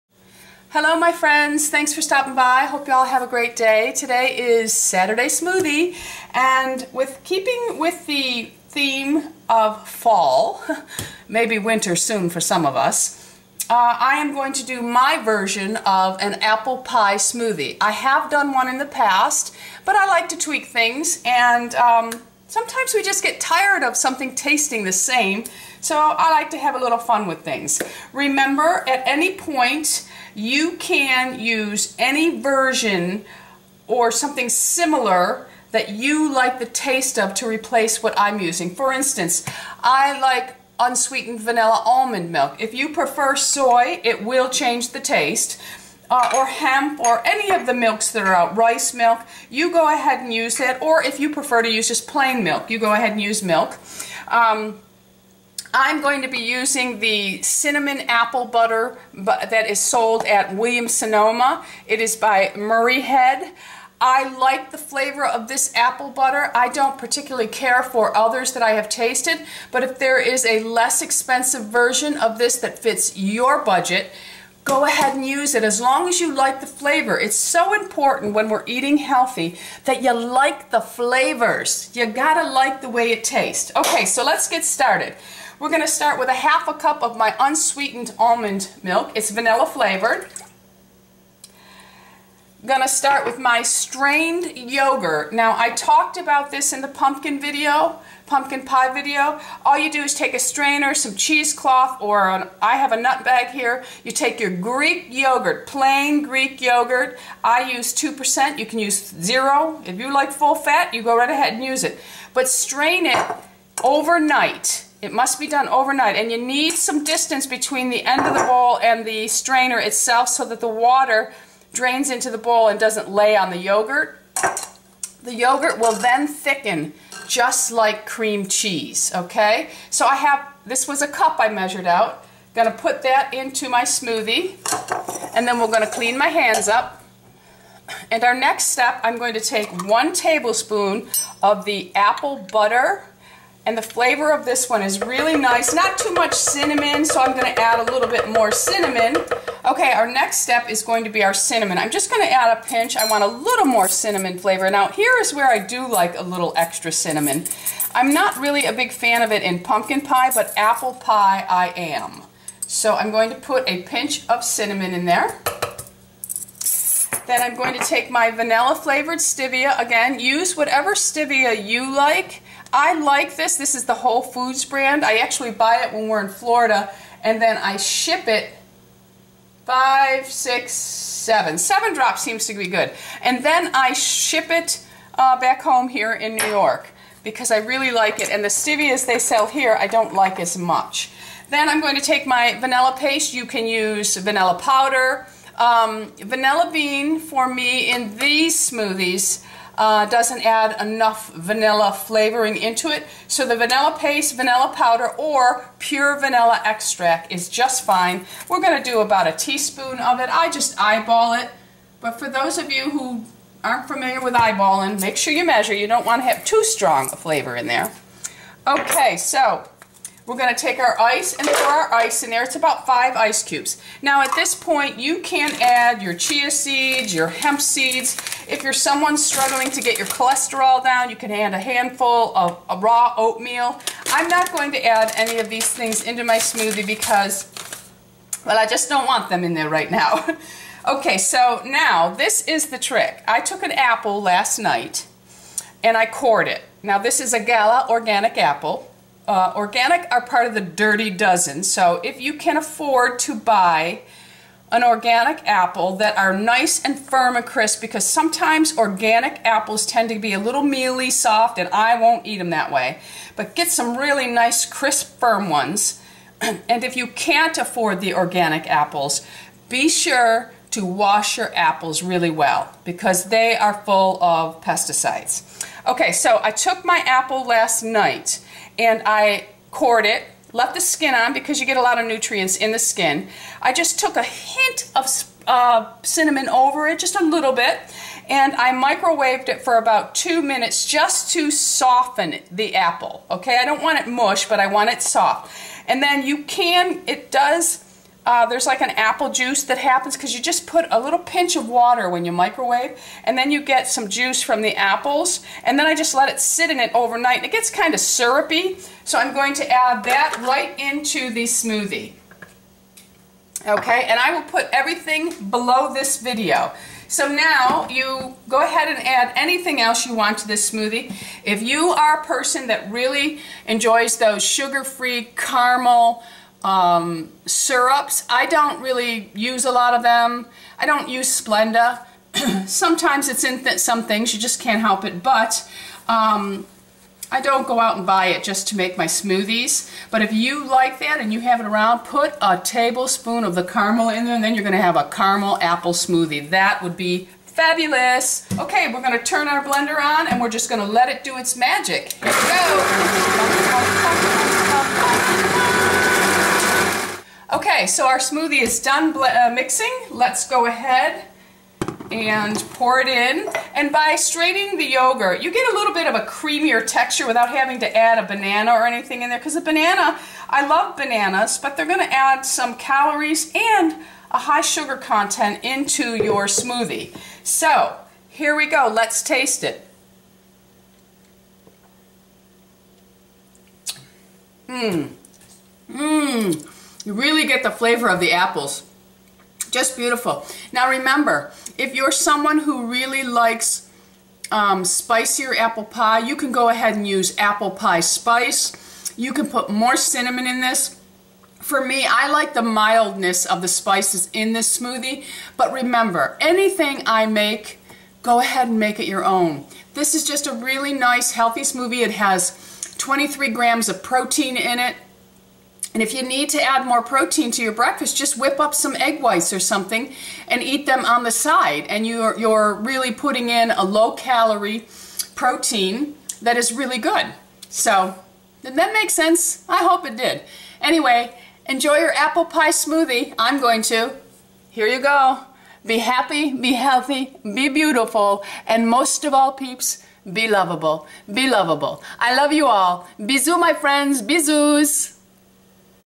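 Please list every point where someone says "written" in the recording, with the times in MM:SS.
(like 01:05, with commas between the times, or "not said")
not said.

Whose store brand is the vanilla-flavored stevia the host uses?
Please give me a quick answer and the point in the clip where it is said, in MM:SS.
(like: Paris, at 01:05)
Whole Foods, at 02:53.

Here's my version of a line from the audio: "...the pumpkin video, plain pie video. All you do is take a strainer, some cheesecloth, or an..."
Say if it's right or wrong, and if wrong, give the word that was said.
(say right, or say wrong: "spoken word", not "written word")
wrong: "pumpkin", not "plain".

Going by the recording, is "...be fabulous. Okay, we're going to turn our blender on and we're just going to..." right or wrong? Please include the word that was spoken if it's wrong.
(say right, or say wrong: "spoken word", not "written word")
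right.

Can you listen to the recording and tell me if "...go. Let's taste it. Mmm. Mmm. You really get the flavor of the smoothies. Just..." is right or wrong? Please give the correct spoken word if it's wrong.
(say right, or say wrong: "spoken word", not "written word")
wrong: "apples", not "smoothies".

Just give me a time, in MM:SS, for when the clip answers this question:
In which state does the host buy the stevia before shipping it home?
02:56.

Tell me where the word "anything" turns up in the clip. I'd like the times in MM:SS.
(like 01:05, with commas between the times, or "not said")
05:19, 06:08, 06:46.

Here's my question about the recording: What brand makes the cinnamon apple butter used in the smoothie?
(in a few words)
Muirhead.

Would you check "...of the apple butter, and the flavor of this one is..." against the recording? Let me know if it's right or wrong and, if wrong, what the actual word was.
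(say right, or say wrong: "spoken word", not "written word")
right.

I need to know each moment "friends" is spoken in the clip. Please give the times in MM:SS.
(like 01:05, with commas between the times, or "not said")
00:01, 07:23.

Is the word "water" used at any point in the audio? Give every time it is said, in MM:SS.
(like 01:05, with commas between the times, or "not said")
02:00, 05:01.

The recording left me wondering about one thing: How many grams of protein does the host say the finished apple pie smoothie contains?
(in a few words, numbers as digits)
23.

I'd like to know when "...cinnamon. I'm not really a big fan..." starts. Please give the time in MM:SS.
02:36.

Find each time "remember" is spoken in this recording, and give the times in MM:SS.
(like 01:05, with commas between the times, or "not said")
00:28, 06:30, 06:45.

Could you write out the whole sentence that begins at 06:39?
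You can put more cinnamon in this.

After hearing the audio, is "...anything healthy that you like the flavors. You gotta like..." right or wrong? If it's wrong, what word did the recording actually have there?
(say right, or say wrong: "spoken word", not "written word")
wrong: "eating", not "anything".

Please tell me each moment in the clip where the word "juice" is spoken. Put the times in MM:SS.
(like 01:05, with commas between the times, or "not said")
04:59, 05:04.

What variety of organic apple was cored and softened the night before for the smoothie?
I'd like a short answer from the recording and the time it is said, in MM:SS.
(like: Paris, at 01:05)
Gala, at 04:07.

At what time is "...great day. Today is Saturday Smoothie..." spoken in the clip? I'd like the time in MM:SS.
00:03.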